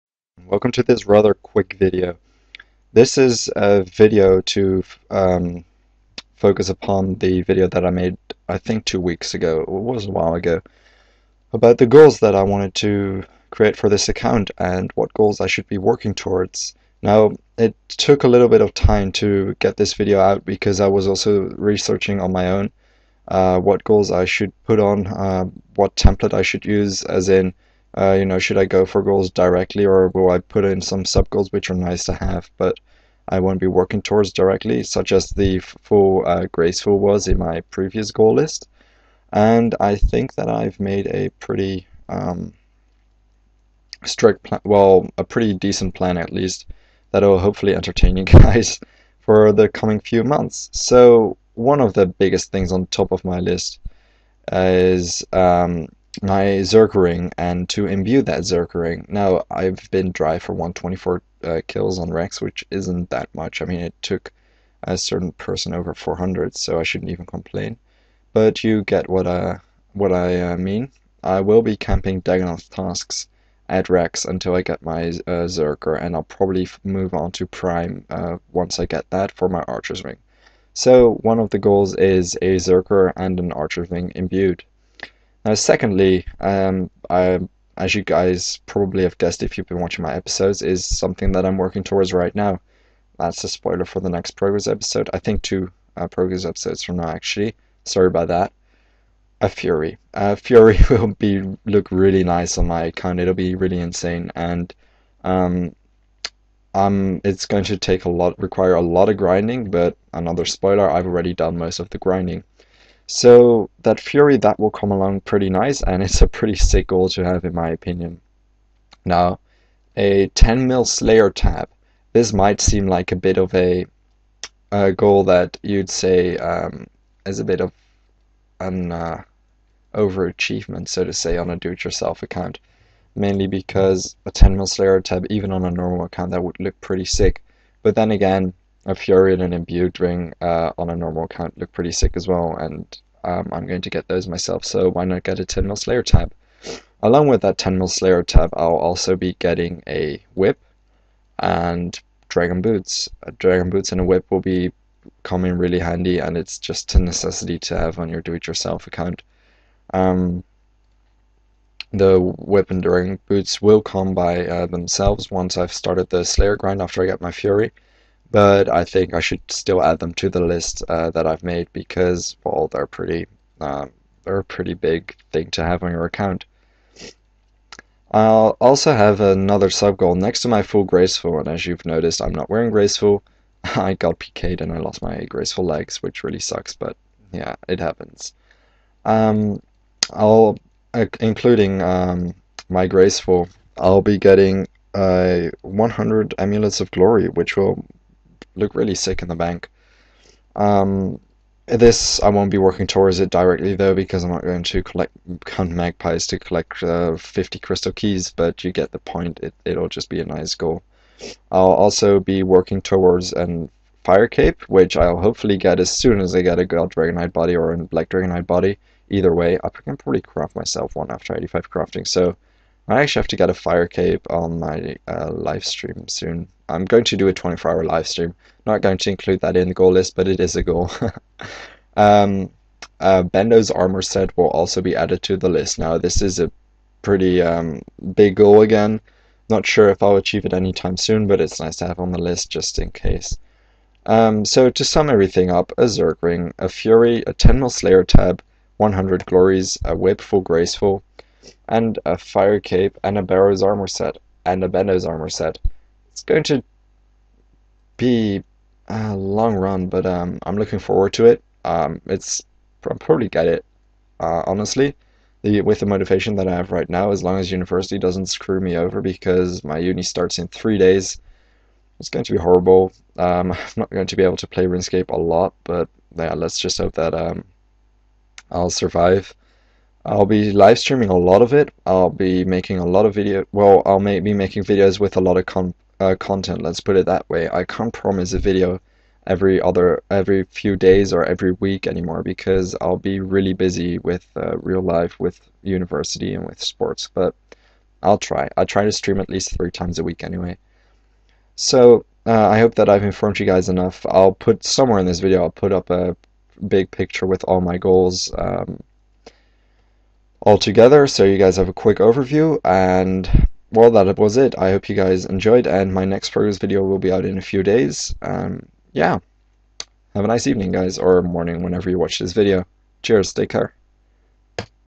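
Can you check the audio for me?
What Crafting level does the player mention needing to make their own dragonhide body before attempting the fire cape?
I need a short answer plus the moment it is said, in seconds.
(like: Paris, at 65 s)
85, at 221 s.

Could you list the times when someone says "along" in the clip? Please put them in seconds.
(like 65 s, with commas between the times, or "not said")
114 s, 147 s.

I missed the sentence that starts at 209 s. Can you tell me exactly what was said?
It it'll just be a nice goal.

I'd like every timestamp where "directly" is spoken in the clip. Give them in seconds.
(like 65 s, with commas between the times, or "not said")
29 s, 34 s, 203 s.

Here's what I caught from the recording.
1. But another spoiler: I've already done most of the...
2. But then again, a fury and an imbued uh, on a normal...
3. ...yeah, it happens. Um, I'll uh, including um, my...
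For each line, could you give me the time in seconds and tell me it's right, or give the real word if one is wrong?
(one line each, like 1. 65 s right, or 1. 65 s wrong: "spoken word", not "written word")
1. 109 s right
2. 137 s right
3. 187 s right.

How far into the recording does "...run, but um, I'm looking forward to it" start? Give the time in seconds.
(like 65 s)
259 s.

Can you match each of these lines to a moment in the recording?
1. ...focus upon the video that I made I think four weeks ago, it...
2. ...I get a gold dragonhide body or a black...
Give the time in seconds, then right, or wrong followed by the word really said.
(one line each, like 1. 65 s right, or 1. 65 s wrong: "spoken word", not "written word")
1. 6 s wrong: "two", not "four"
2. 216 s right.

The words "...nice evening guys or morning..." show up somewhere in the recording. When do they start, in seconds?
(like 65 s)
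320 s.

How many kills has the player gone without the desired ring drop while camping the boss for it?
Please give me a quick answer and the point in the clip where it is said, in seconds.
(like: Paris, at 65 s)
124, at 60 s.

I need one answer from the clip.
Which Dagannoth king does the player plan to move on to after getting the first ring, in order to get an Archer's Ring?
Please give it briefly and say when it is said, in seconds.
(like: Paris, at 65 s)
Prime, at 77 s.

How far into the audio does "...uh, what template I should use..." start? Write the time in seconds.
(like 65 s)
25 s.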